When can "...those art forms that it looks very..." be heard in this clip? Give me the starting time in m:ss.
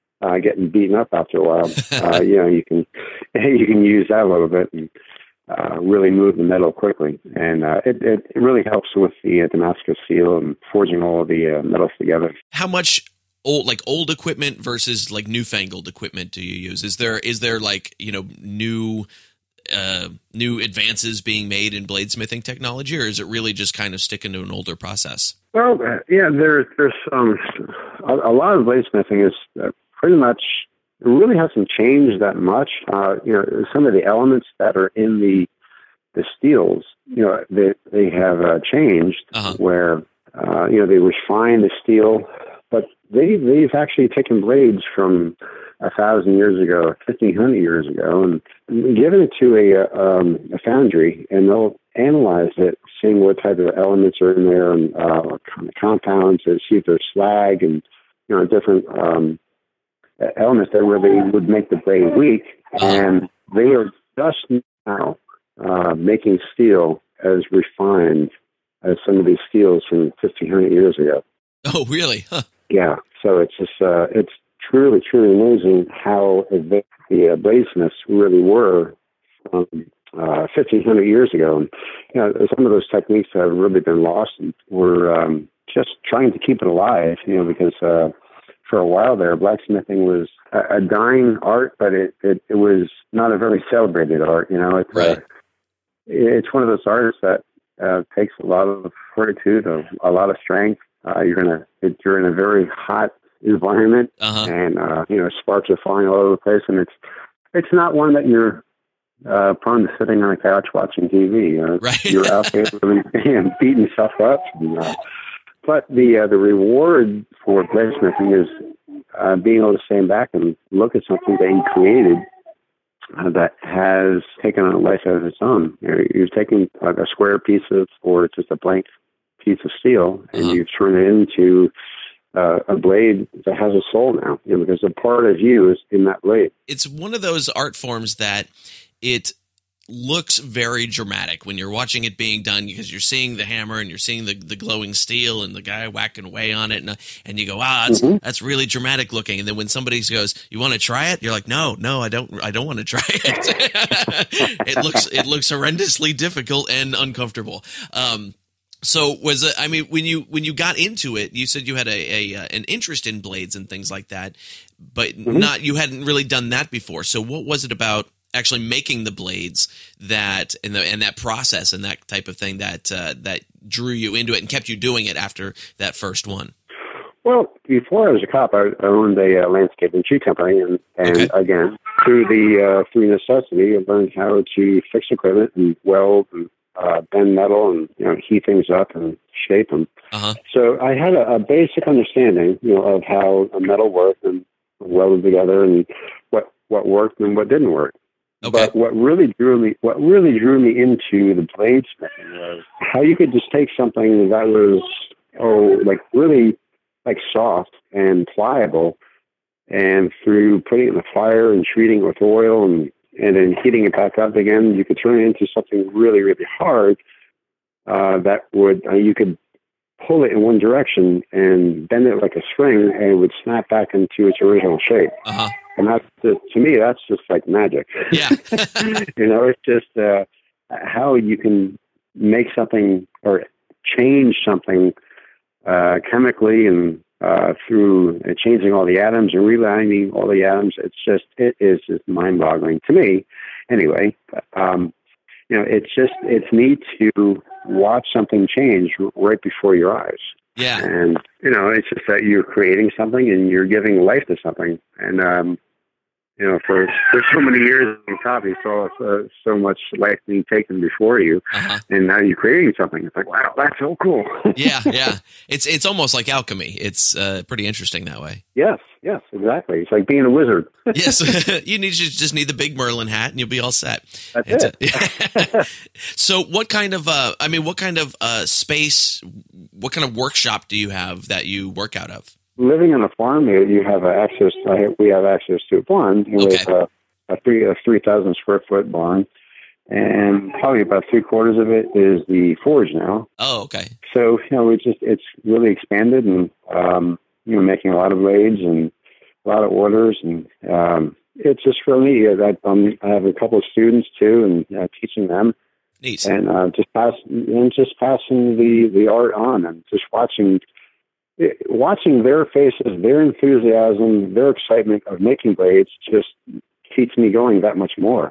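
2:17.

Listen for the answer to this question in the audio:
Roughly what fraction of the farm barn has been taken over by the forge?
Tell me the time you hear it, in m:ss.
4:51.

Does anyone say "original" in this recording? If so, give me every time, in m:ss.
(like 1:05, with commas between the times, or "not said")
3:44.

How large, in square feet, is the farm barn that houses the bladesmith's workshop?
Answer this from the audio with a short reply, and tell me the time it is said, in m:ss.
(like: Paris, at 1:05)
3000, at 4:47.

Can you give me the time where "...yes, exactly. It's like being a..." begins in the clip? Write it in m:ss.
4:29.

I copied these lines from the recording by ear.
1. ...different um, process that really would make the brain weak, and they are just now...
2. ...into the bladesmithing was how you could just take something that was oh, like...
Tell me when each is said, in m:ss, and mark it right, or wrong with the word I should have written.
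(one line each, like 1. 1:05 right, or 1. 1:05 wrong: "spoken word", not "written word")
1. 0:58 wrong: "illness", not "process"
2. 3:20 right.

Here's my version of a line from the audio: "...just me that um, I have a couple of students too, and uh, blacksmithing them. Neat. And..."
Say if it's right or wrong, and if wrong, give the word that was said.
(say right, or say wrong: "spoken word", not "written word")
wrong: "teaching", not "blacksmithing".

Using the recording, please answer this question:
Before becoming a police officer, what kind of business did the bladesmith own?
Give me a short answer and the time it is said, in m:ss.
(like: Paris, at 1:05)
landscape and tree company, at 2:59.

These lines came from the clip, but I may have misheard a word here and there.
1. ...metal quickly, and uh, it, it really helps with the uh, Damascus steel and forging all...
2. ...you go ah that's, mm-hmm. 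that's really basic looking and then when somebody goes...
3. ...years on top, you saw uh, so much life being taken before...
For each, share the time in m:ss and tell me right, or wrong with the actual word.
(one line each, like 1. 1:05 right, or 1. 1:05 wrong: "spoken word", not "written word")
1. 0:06 right
2. 2:27 wrong: "dramatic", not "basic"
3. 4:17 right.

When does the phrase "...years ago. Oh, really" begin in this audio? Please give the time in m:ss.
1:10.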